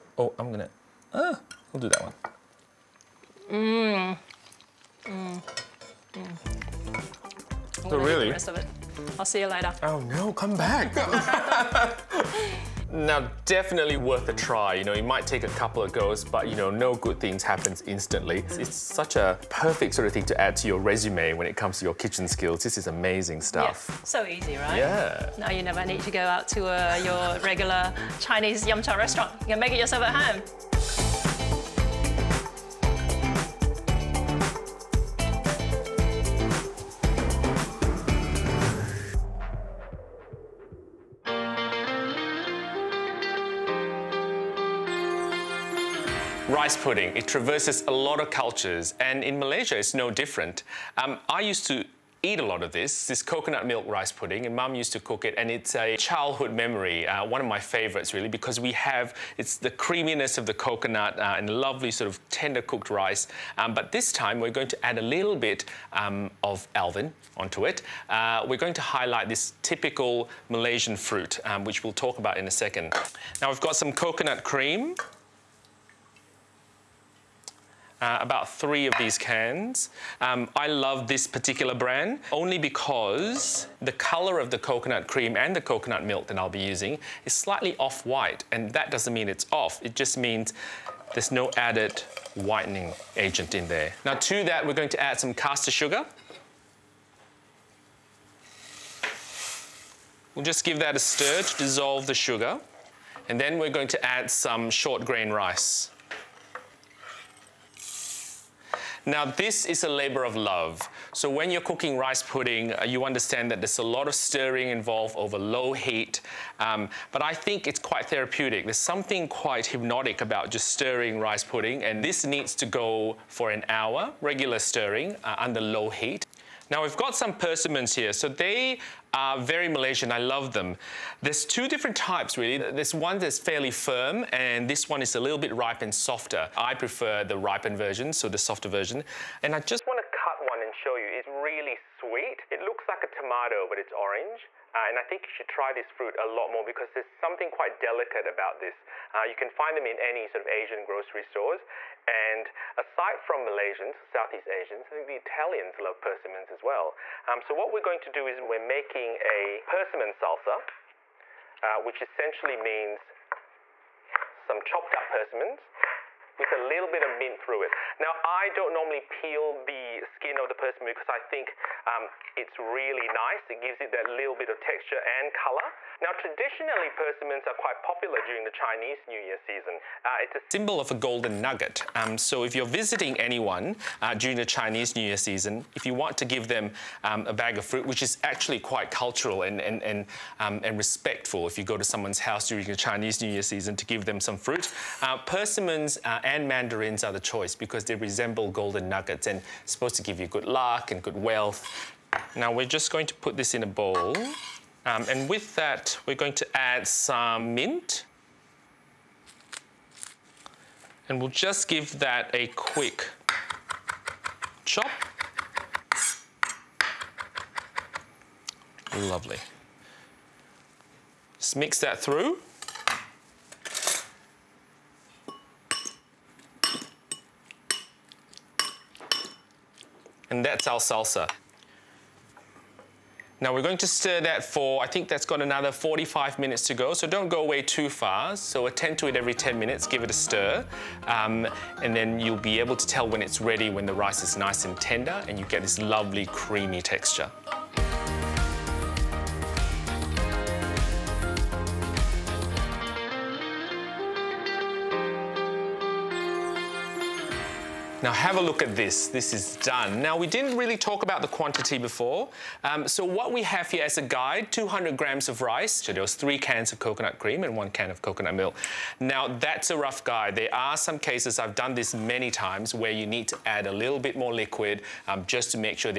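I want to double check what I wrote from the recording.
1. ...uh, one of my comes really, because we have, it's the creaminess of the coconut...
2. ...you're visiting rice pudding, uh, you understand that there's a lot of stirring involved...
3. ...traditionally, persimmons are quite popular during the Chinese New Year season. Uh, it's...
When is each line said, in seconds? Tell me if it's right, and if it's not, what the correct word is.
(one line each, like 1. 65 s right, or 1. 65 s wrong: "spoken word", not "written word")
1. 57 s wrong: "favourites", not "comes"
2. 111 s wrong: "cooking", not "visiting"
3. 176 s right.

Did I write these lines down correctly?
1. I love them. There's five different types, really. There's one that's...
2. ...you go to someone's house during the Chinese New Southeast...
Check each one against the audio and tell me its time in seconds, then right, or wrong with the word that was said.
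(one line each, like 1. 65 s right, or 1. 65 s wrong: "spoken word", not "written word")
1. 130 s wrong: "two", not "five"
2. 191 s wrong: "Year", not "Southeast".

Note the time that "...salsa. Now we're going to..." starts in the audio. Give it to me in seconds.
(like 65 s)
230 s.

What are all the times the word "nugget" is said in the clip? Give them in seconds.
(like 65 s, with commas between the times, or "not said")
181 s, 198 s.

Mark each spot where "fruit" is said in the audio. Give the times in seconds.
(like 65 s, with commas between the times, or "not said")
70 s, 145 s, 187 s, 194 s.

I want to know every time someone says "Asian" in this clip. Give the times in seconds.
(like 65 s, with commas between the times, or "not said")
150 s, 154 s.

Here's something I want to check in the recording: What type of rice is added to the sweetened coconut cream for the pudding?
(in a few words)
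short grain rice.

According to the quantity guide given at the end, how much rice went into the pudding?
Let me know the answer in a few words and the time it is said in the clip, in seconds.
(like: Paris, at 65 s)
200 grams, at 264 s.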